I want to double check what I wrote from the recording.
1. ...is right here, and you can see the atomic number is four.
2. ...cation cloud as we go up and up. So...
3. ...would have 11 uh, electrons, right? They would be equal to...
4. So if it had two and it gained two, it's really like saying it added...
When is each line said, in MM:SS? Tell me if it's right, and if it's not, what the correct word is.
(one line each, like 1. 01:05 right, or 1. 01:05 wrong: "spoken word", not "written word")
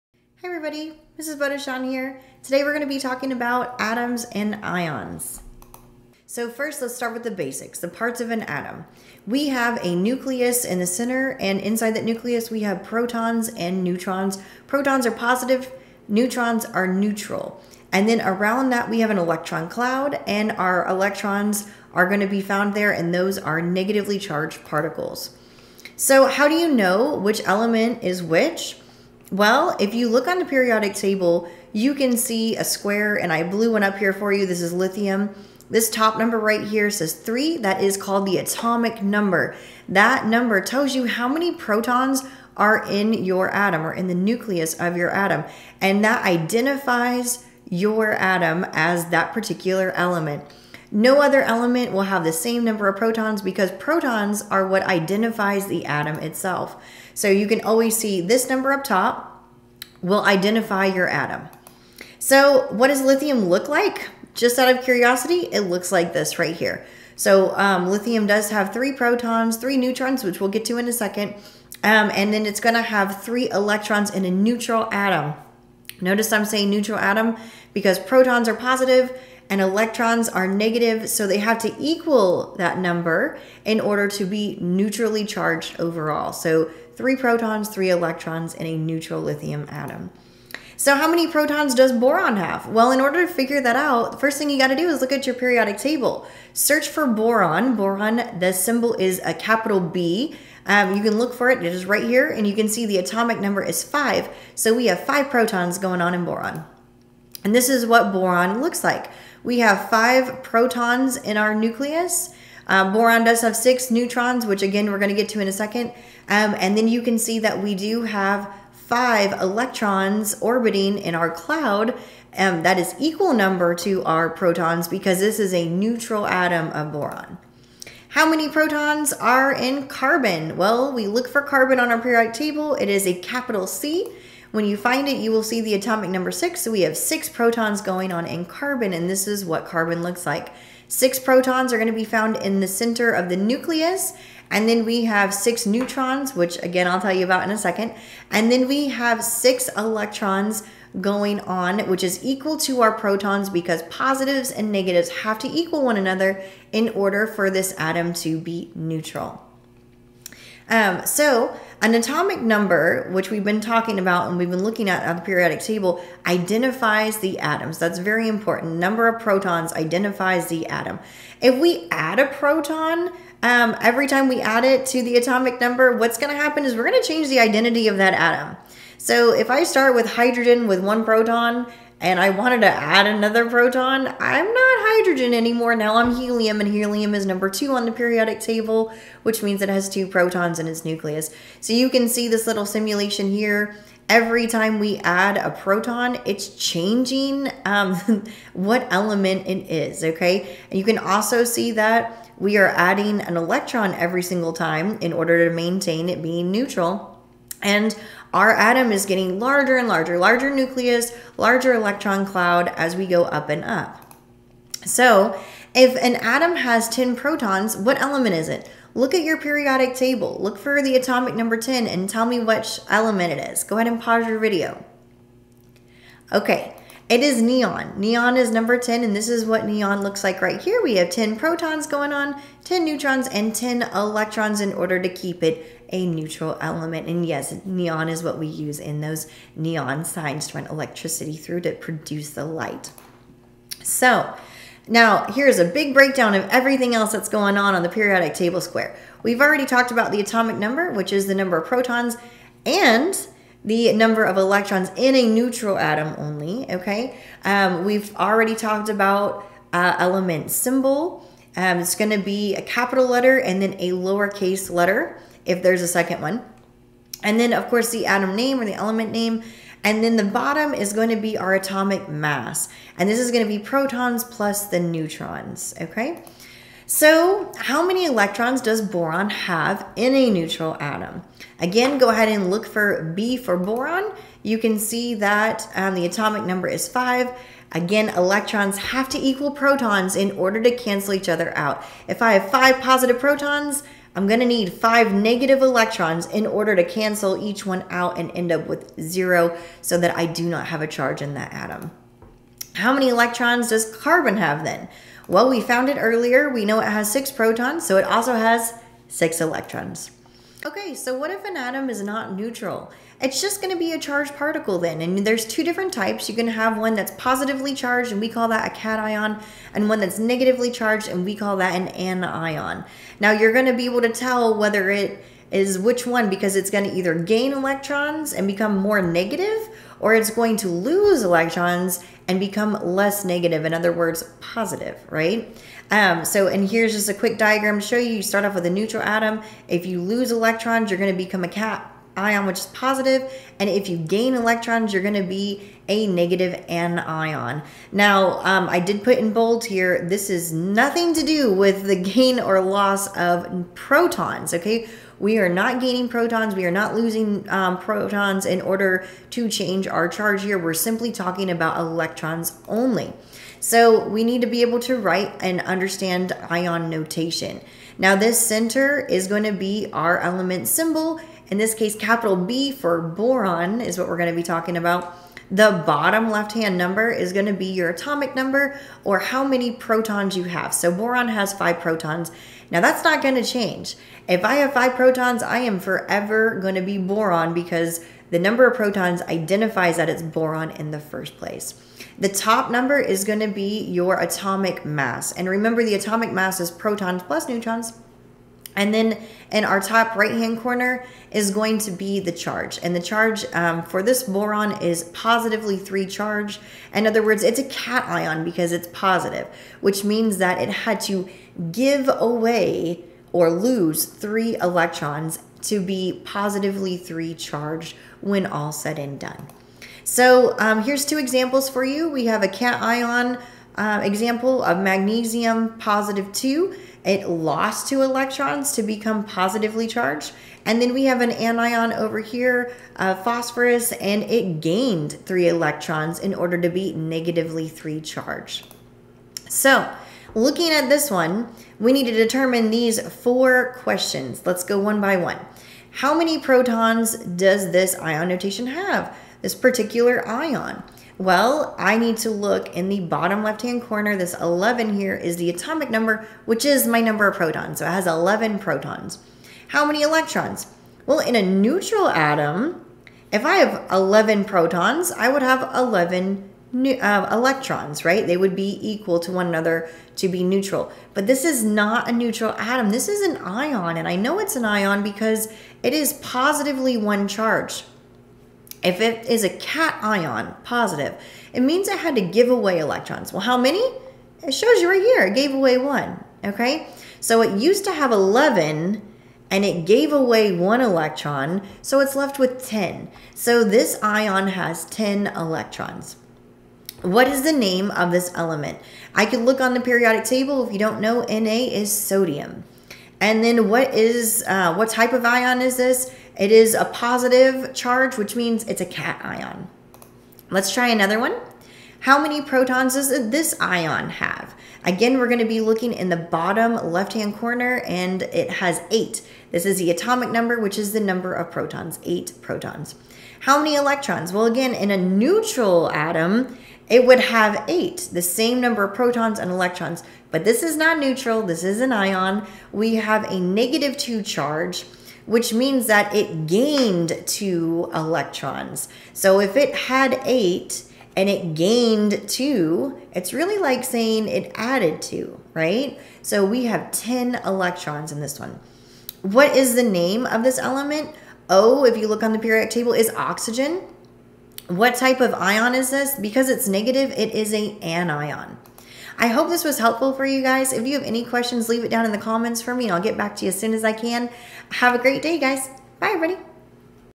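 1. 01:41 wrong: "five", not "four"
2. 03:31 wrong: "electron", not "cation"
3. 07:45 right
4. 08:59 wrong: "eight", not "two".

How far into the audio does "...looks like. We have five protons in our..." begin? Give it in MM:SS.
01:48.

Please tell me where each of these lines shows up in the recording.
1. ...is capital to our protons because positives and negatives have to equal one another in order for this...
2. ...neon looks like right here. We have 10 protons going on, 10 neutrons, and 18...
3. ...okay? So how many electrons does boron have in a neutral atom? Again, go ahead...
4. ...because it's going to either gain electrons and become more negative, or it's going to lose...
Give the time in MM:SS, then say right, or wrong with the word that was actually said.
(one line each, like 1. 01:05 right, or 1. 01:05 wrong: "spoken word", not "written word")
1. 02:32 wrong: "equal", not "capital"
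2. 03:49 wrong: "10", not "18"
3. 04:35 right
4. 05:26 right.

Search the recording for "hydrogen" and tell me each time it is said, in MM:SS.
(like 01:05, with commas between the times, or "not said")
03:00, 03:04.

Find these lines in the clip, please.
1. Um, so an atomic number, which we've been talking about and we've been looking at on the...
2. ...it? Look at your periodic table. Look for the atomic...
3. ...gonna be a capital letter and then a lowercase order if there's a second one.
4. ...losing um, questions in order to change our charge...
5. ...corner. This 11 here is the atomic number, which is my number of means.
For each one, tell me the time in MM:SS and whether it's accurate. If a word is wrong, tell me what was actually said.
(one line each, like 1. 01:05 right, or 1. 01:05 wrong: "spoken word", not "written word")
1. 02:40 right
2. 03:38 right
3. 04:21 wrong: "letter", not "order"
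4. 05:56 wrong: "protons", not "questions"
5. 07:33 wrong: "protons", not "means".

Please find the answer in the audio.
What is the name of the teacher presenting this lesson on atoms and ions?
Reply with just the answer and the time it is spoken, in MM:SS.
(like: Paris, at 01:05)
Mrs. Bodechon, at 00:01.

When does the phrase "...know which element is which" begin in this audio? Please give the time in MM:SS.
00:26.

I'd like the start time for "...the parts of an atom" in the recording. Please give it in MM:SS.
00:07.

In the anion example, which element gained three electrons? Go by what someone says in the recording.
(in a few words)
Phosphorus.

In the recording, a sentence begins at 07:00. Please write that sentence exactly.
So um, here's two examples for you.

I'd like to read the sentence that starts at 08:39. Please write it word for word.
This is the atomic number, which is the number of protons, eight protons.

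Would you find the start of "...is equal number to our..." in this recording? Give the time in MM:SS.
02:02.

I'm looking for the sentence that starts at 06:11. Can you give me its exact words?
In this case, capital B for boron is what we're going to be talking about.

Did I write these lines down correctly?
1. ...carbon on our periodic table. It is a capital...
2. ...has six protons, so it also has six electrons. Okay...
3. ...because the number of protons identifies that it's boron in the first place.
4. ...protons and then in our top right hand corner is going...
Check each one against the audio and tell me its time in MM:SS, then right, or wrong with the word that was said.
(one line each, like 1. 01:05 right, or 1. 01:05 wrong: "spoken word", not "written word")
1. 02:11 right
2. 05:06 right
3. 06:27 right
4. 06:37 wrong: "neutrons", not "protons".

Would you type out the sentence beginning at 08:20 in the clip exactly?
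If you don't know, Na is sodium.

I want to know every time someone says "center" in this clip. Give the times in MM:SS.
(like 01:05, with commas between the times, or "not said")
00:10, 02:22, 06:08.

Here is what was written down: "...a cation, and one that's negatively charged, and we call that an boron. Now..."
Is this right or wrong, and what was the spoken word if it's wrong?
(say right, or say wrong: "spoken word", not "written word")
wrong: "anion", not "boron".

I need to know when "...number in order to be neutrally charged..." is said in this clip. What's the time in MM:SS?
01:22.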